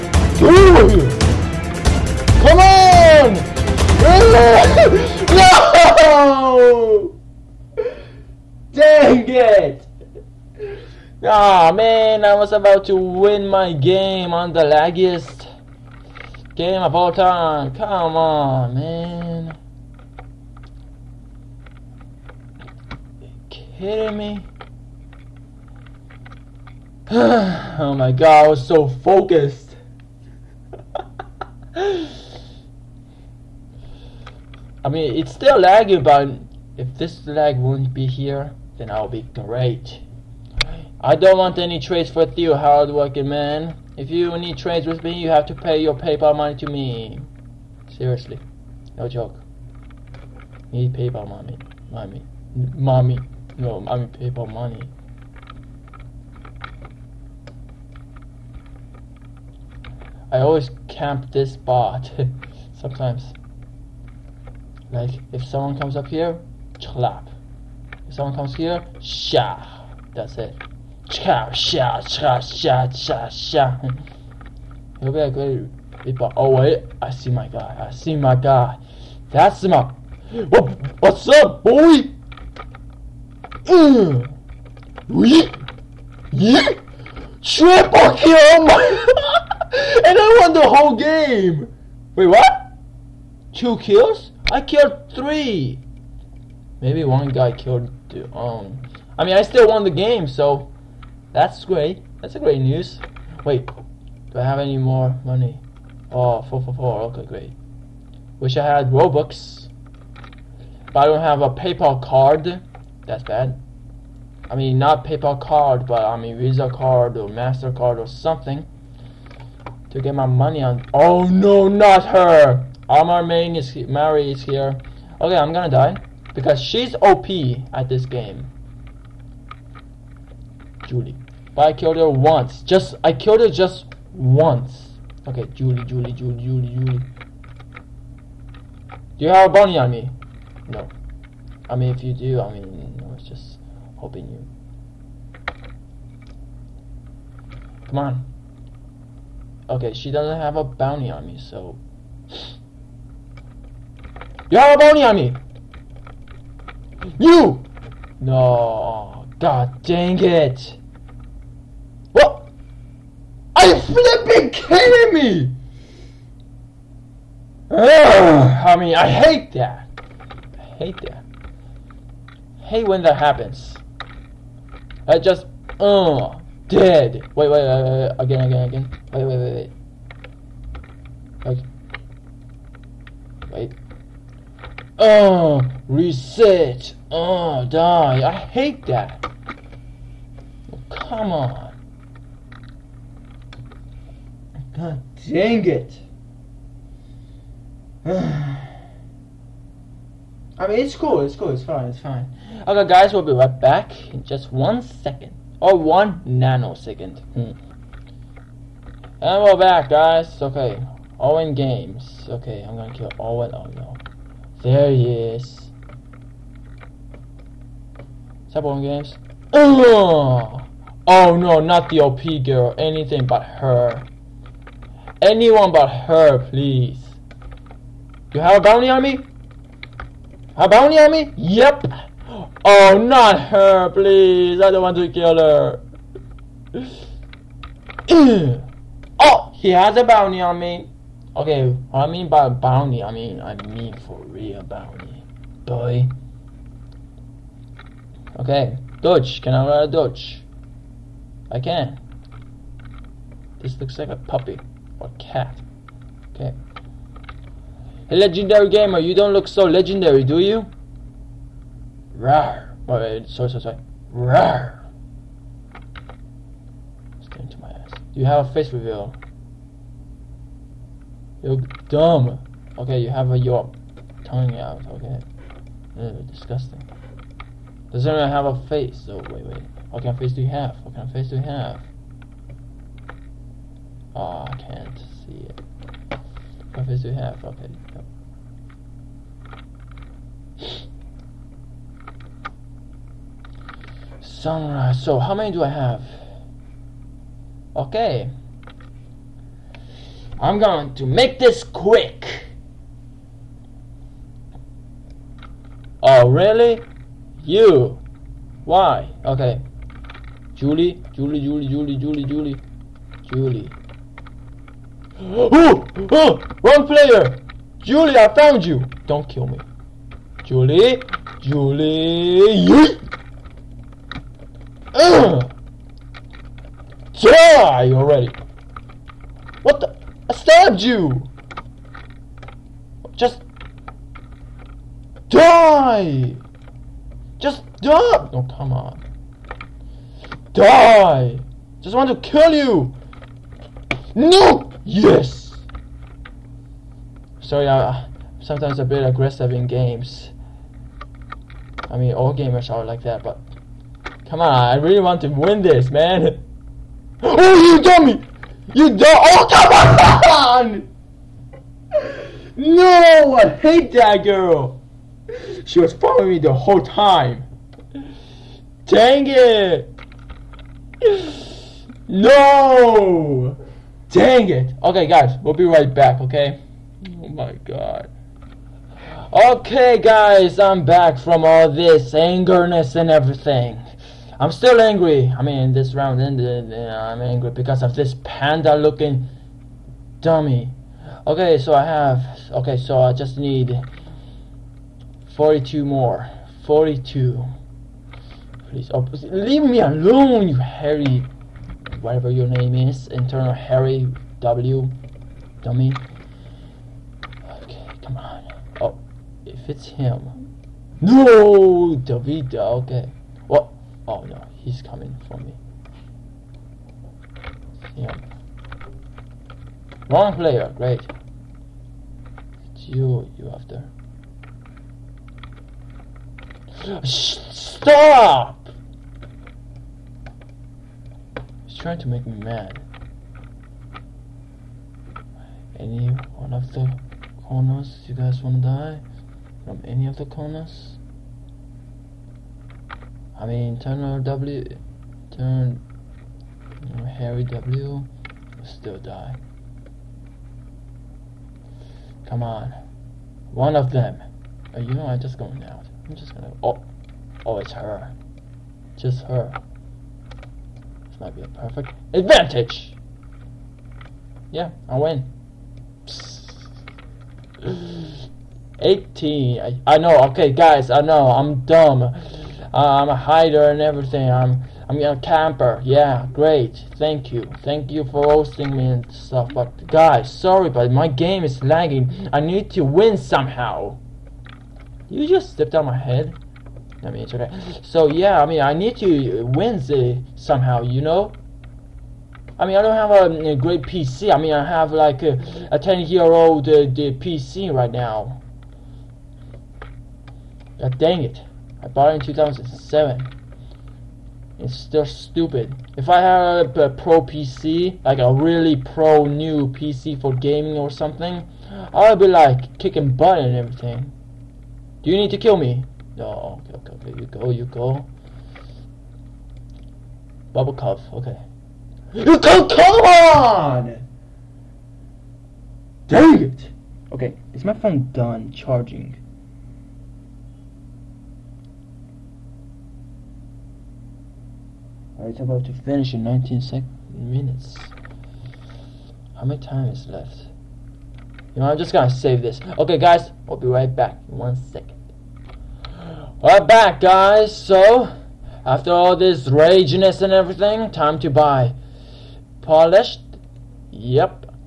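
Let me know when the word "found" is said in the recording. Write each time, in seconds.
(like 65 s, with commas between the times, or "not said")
318 s.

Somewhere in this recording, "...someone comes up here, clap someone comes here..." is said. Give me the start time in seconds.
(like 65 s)
65 s.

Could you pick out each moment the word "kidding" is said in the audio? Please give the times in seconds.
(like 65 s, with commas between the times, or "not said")
23 s, 164 s.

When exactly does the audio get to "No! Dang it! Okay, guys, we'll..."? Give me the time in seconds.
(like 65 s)
372 s.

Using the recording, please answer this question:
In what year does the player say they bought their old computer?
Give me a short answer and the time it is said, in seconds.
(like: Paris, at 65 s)
2007, at 502 s.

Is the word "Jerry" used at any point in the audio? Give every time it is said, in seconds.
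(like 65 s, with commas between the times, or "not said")
not said.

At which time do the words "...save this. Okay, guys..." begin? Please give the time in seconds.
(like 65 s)
542 s.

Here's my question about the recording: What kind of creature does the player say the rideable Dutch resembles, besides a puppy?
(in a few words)
cat.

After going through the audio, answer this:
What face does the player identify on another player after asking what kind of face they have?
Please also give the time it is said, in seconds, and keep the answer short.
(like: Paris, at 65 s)
Sunrise, at 294 s.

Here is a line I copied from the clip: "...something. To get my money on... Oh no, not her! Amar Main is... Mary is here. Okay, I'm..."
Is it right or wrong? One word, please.
right.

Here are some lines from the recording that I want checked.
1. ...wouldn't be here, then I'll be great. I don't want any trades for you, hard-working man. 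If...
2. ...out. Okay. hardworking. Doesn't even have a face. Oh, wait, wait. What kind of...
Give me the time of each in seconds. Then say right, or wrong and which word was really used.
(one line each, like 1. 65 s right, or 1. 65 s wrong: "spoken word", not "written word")
1. 37 s right
2. 274 s wrong: "disgusting", not "hardworking".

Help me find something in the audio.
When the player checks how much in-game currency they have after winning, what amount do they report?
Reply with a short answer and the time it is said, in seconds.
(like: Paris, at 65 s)
444, at 106 s.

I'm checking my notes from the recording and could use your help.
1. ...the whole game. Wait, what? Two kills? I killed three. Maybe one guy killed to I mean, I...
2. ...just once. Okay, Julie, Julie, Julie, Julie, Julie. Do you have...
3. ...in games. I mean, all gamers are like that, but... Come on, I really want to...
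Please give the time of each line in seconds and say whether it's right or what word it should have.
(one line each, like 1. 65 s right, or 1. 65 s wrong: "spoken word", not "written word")
1. 90 s right
2. 133 s right
3. 349 s right.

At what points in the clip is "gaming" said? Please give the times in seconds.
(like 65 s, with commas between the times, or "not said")
510 s.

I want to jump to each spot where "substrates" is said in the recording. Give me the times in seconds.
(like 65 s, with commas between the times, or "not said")
not said.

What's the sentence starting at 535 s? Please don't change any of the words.
it's about to finish in 19 sec minutes.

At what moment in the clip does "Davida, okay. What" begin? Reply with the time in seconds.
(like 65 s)
411 s.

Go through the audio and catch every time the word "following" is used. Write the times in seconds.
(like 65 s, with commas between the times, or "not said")
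365 s.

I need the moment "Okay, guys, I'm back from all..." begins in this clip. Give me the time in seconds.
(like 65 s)
379 s.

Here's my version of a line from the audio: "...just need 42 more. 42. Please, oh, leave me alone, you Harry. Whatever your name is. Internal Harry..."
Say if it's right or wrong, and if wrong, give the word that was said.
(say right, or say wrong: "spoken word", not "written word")
right.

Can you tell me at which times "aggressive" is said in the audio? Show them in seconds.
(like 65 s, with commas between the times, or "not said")
349 s.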